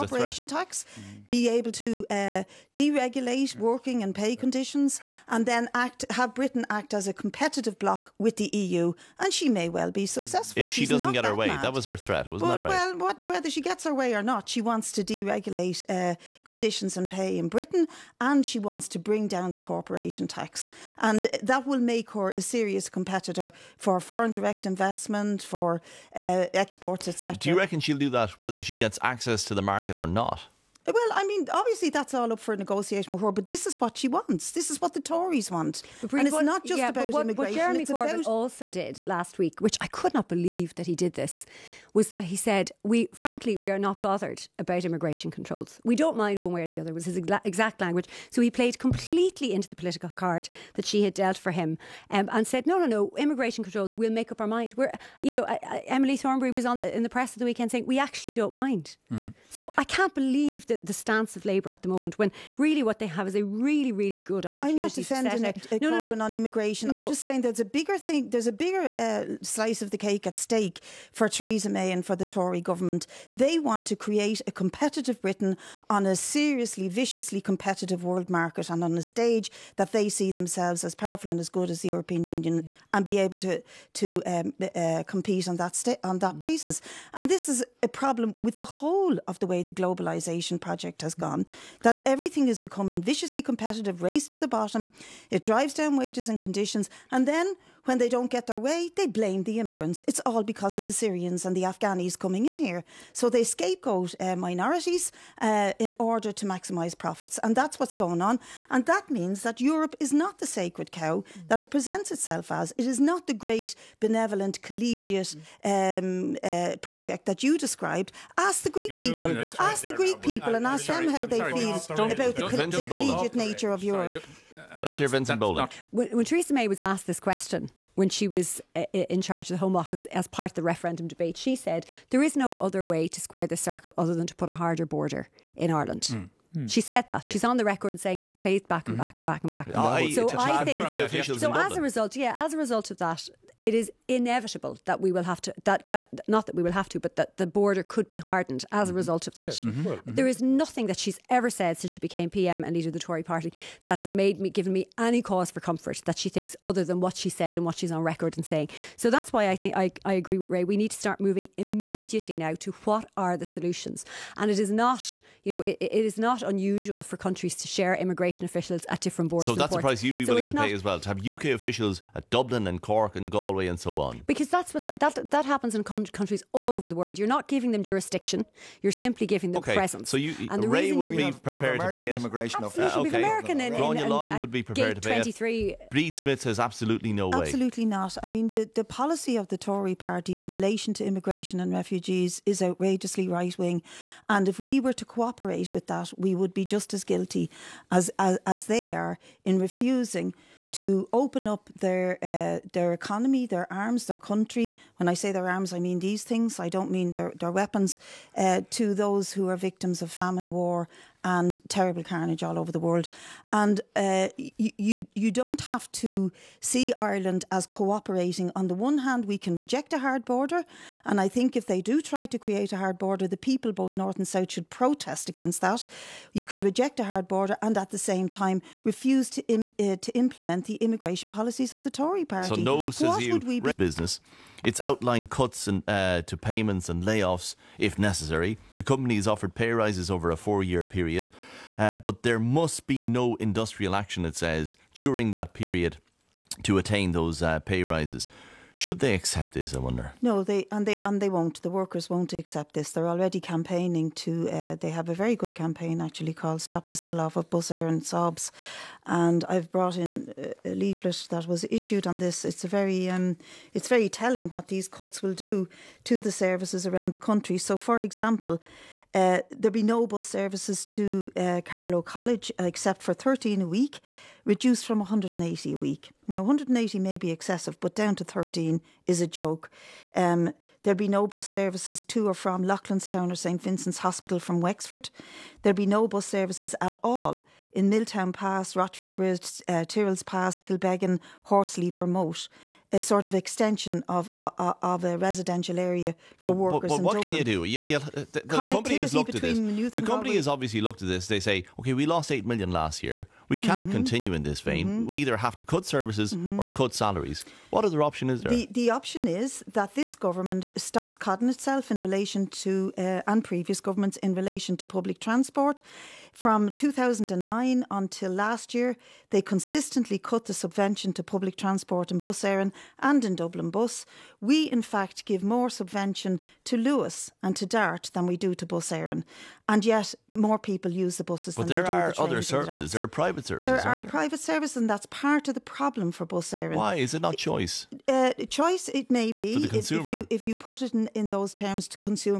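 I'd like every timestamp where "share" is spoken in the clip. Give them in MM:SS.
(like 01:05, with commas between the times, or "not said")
02:47.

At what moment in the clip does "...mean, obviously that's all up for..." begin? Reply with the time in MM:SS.
00:31.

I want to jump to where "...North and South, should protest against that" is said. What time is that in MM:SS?
03:43.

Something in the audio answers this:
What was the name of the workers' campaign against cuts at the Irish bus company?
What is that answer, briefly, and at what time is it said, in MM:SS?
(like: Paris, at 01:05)
Stop the Sell-off of Bus Eireann, at 04:16.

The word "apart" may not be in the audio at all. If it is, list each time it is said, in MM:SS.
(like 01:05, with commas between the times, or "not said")
not said.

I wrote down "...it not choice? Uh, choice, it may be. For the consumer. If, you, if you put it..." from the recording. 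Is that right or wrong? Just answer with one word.
right.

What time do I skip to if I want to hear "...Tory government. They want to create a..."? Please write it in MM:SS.
01:12.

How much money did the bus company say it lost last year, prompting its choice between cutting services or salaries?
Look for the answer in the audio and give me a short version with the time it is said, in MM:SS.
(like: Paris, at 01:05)
8 million, at 05:02.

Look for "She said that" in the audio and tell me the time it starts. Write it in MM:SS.
02:16.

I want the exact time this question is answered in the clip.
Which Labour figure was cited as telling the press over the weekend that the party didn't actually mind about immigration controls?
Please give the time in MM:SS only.
00:55.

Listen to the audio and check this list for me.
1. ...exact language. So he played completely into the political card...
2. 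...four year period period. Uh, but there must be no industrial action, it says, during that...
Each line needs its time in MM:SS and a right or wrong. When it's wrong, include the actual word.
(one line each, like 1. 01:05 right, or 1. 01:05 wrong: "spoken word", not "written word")
1. 00:47 right
2. 04:00 right.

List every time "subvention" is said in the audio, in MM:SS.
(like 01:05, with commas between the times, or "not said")
05:20, 05:25.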